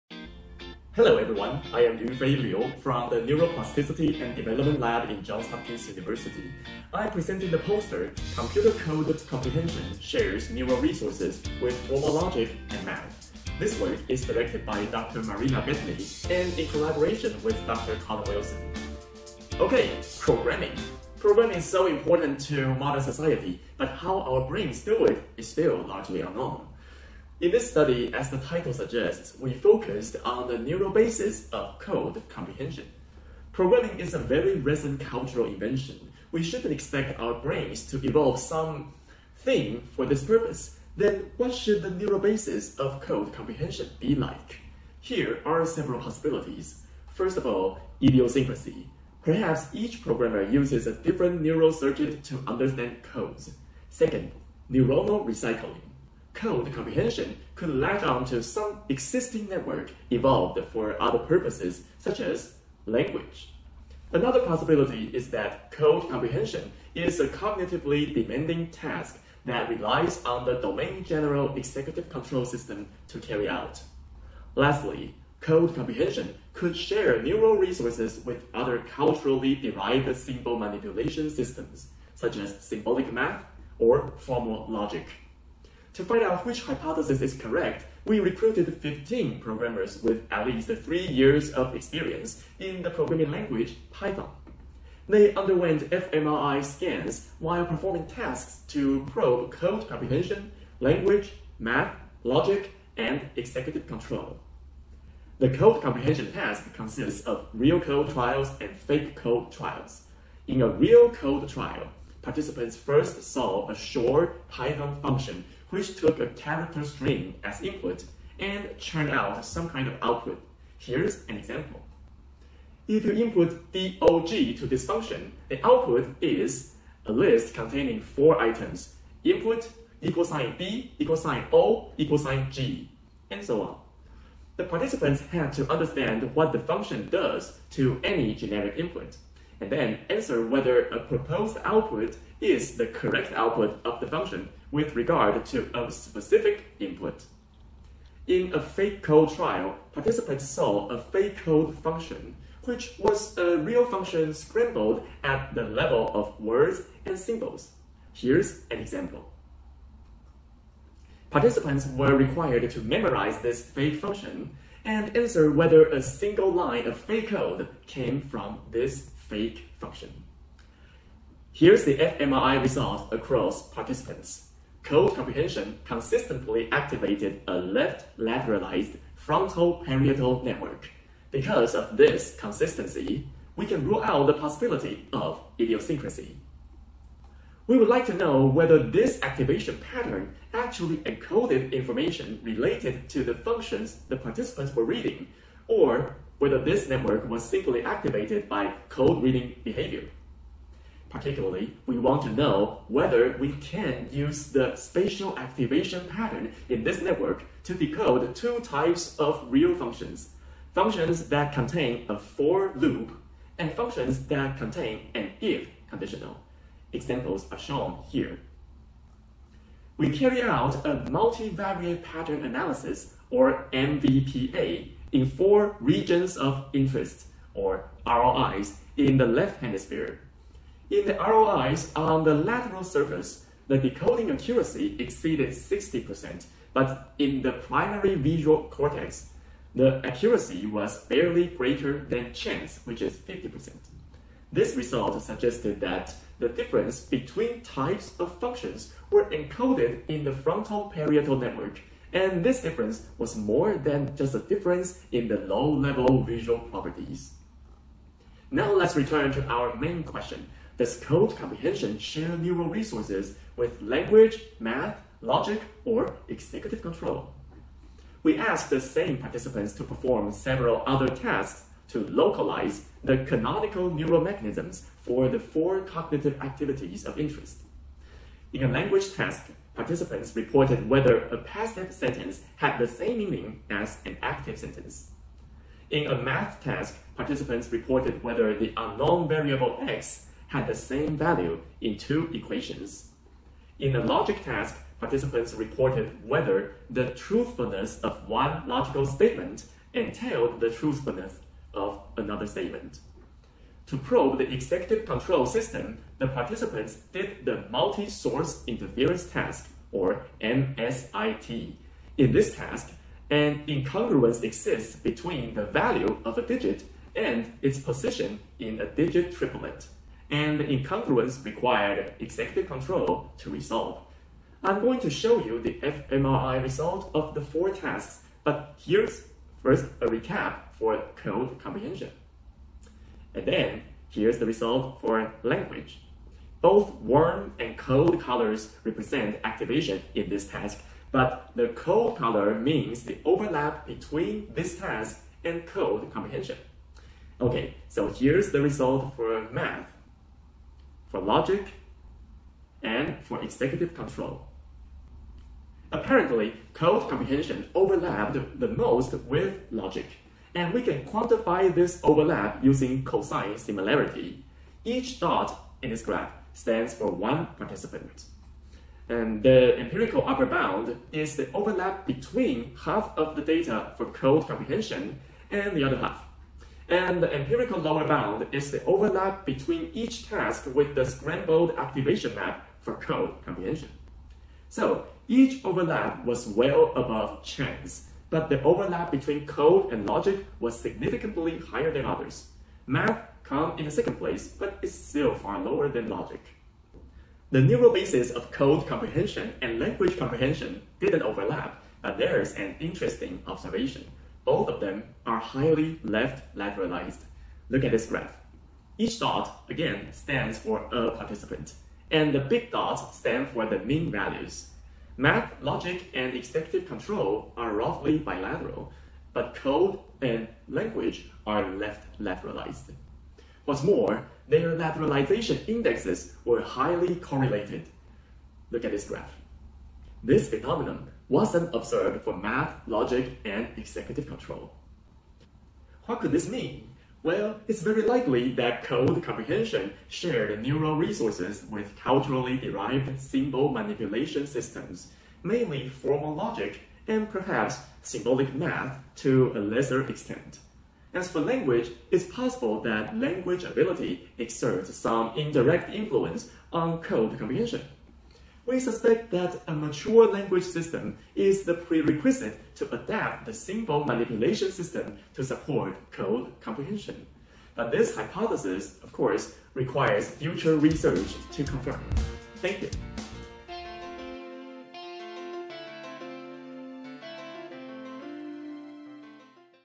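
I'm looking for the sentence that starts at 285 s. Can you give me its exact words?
In a math task, participants reported whether the unknown variable x had the same value in two equations.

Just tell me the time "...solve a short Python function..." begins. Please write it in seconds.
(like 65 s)
113 s.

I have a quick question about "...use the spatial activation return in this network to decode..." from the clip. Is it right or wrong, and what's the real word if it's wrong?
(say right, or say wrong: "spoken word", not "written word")
wrong: "pattern", not "return".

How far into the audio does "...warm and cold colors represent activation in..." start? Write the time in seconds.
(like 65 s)
336 s.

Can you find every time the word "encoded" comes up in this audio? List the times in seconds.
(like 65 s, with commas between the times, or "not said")
191 s, 249 s.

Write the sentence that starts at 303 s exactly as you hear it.
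To probe the executive control system, the participants did the Multi-Source Interference Task, or MSIT.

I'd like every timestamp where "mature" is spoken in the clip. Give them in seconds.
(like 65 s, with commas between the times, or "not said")
459 s.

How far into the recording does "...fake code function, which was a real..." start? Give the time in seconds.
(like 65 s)
150 s.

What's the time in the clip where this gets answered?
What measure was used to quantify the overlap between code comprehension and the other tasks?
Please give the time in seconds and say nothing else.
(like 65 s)
363 s.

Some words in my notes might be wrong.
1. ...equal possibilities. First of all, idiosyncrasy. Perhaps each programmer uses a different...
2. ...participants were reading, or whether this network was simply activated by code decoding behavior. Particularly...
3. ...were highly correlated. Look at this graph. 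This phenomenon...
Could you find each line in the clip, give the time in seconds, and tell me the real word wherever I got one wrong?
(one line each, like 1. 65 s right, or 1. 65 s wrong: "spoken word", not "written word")
1. 45 s wrong: "several", not "equal"
2. 194 s wrong: "reading", not "decoding"
3. 426 s right.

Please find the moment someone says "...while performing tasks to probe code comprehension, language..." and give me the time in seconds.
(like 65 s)
97 s.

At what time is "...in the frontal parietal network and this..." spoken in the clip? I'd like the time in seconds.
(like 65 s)
250 s.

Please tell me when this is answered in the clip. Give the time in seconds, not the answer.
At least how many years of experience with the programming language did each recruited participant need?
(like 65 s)
90 s.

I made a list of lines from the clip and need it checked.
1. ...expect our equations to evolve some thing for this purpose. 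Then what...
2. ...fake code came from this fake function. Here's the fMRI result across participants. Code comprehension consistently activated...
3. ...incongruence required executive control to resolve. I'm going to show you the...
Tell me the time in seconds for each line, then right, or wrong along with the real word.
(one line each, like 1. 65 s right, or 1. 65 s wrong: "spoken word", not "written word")
1. 36 s wrong: "brains", not "equations"
2. 166 s right
3. 320 s right.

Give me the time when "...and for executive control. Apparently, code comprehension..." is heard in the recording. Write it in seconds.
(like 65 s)
352 s.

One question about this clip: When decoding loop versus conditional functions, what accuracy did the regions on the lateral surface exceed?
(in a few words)
60%.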